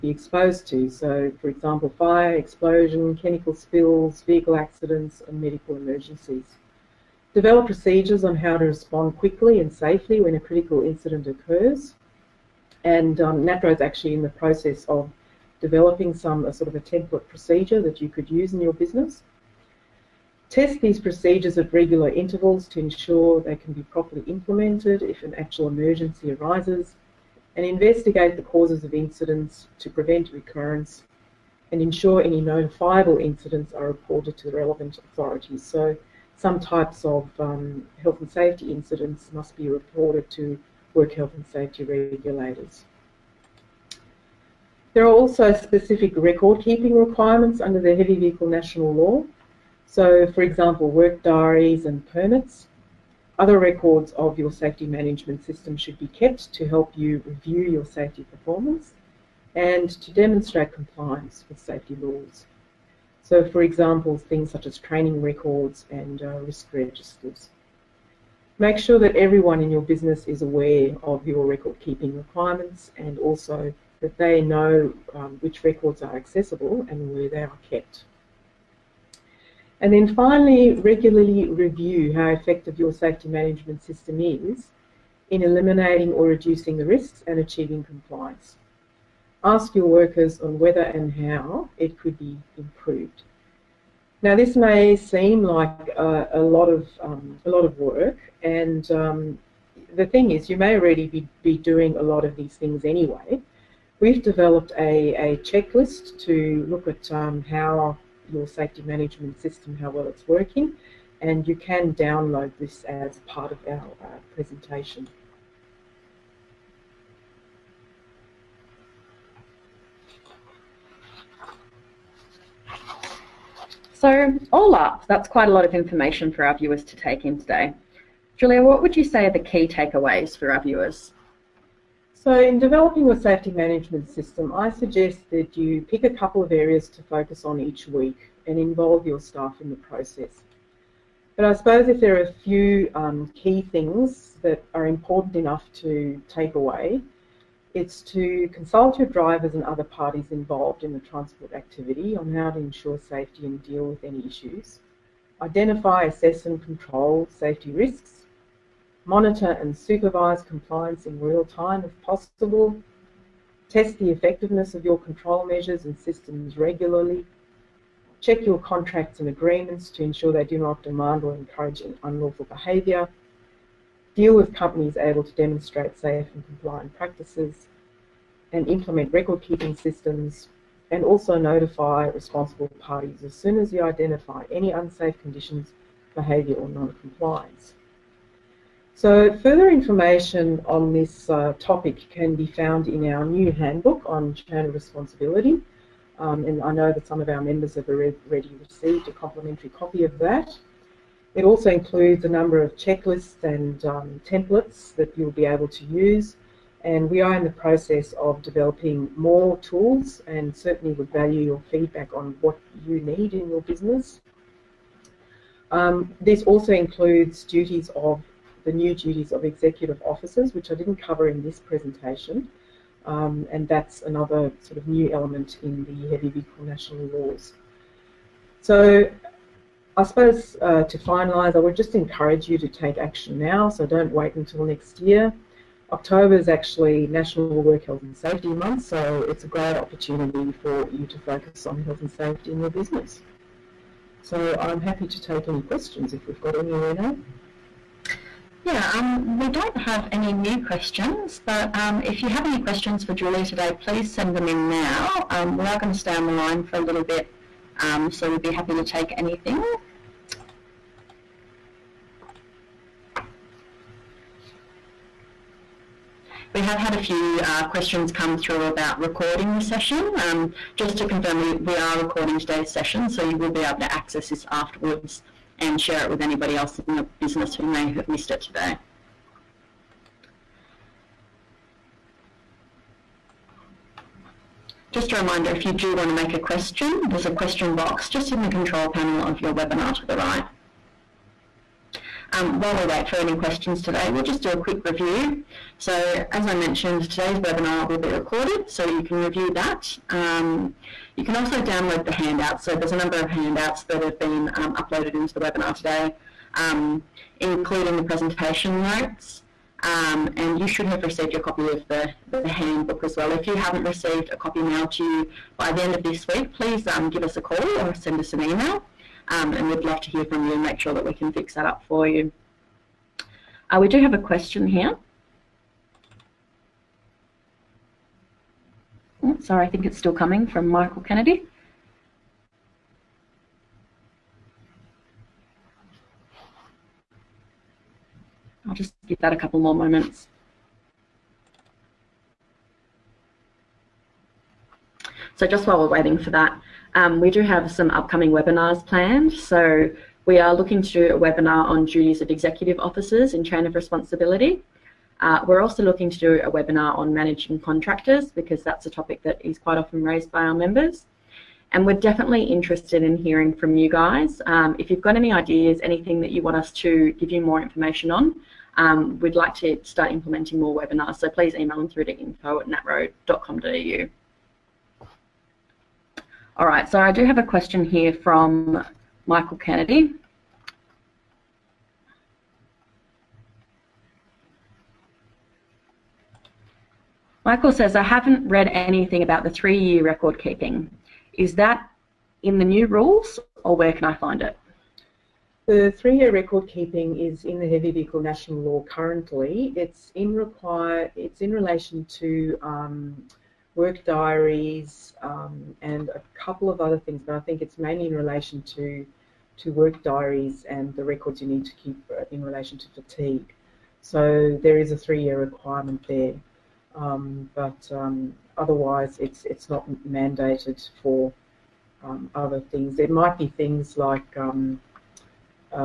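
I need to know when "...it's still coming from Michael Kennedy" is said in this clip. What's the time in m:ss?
5:29.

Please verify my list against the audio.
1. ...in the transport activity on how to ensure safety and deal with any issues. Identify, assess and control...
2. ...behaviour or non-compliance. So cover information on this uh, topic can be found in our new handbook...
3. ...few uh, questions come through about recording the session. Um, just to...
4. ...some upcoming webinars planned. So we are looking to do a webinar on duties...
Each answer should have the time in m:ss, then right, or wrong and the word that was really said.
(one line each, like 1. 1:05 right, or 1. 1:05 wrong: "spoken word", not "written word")
1. 2:30 right
2. 3:06 wrong: "further", not "cover"
3. 4:27 right
4. 5:47 right.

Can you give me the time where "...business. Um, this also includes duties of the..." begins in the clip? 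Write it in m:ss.
3:33.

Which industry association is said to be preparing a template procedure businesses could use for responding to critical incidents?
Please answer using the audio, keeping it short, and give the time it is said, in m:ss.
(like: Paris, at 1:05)
NatRoad, at 0:13.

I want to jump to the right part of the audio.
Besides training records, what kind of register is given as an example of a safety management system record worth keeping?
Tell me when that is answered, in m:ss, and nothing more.
1:06.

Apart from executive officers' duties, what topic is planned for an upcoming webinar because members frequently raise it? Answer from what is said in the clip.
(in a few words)
Managing contractors.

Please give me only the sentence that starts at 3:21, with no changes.
It also includes a number of checklists and um, templates that you'll be able to use.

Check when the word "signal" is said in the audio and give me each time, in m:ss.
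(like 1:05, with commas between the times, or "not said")
not said.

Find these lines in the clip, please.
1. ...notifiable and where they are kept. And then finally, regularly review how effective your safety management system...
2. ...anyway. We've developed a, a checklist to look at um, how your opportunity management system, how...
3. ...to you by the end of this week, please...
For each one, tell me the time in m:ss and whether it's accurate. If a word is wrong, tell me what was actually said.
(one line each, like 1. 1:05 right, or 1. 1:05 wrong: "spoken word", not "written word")
1. 1:16 wrong: "accessible", not "notifiable"
2. 1:42 wrong: "safety", not "opportunity"
3. 5:14 right.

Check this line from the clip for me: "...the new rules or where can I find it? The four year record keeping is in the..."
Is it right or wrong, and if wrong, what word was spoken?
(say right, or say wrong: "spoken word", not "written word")
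wrong: "three", not "four".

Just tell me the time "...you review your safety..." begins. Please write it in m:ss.
0:56.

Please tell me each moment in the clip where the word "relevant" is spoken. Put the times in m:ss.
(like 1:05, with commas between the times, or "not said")
0:34.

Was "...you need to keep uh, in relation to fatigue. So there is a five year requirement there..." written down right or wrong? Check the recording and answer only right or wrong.
wrong.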